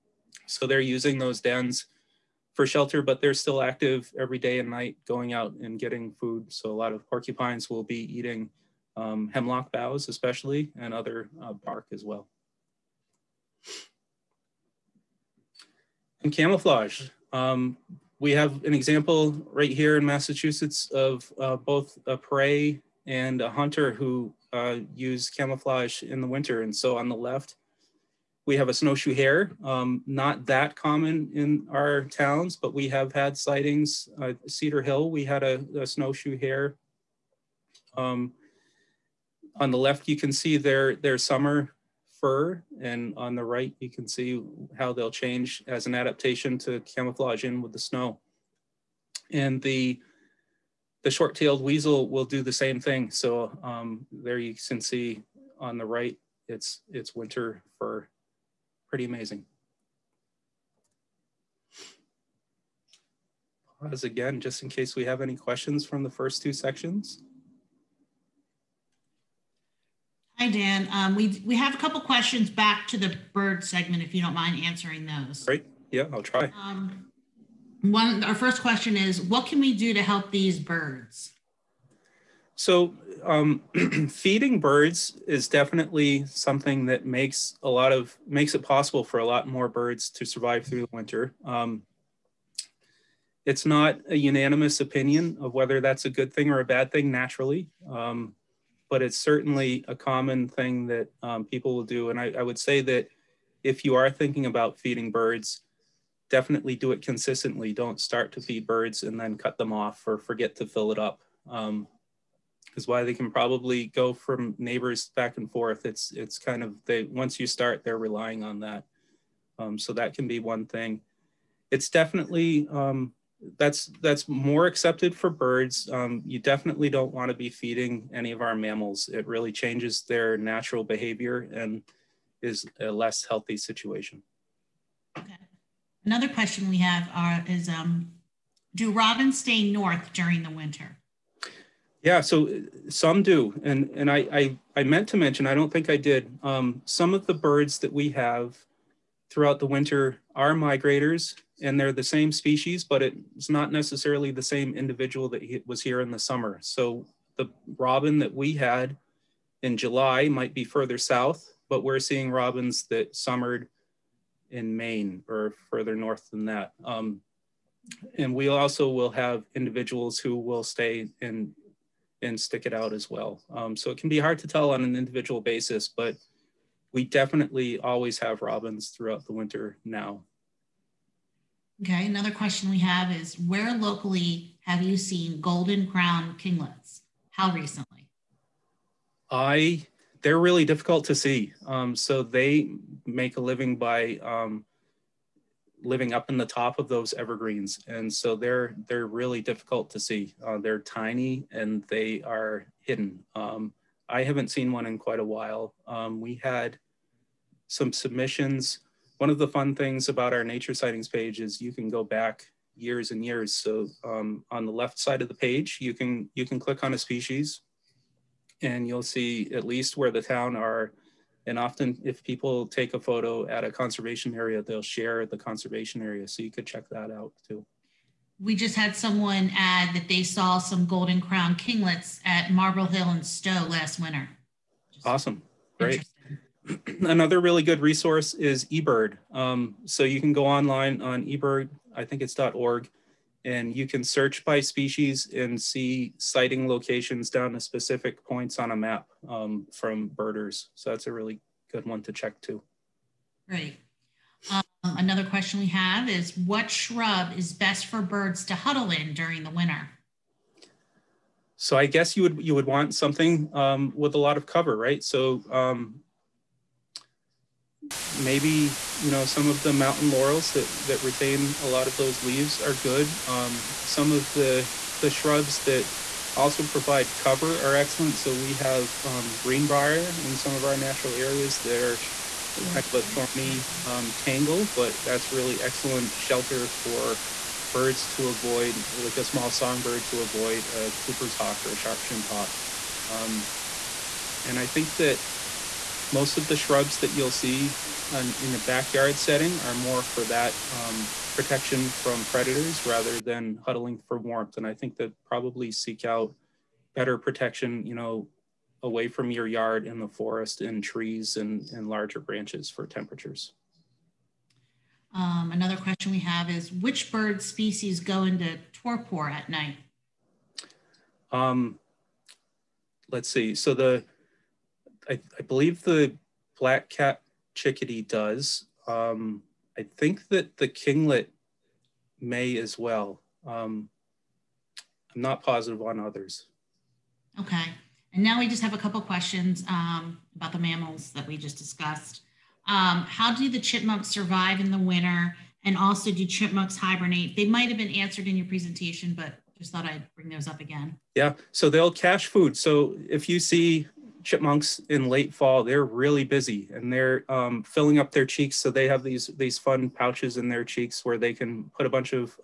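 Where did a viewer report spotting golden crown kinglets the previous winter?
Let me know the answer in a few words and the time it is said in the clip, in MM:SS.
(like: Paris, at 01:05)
Marble Hill, at 03:52.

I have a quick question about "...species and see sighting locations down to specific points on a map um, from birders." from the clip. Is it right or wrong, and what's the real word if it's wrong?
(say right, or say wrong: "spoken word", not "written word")
right.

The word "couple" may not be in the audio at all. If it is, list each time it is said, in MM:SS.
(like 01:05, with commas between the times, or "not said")
01:11, 05:38.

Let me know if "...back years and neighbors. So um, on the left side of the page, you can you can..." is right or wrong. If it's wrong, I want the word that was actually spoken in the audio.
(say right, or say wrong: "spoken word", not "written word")
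wrong: "years", not "neighbors".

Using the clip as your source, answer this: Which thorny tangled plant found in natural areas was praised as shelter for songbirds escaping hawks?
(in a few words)
Greenbrier.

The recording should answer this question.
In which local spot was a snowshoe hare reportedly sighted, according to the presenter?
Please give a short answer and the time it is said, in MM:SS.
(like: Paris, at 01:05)
Cedar Hill, at 00:34.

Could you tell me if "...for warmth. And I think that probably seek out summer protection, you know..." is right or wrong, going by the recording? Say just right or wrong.
wrong.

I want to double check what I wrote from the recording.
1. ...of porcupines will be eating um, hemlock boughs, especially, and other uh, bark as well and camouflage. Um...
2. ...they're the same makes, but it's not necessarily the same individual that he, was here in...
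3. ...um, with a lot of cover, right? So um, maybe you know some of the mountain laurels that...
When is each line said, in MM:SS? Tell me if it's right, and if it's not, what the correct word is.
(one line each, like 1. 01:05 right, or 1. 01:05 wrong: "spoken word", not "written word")
1. 00:06 right
2. 02:31 wrong: "species", not "makes"
3. 04:23 right.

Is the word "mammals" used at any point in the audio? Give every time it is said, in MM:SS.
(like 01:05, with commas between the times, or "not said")
02:08, 05:40.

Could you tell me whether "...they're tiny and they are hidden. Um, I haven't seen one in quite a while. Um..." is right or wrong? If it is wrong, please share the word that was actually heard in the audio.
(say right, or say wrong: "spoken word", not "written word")
right.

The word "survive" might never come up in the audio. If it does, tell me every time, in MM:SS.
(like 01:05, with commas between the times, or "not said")
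01:30, 05:44.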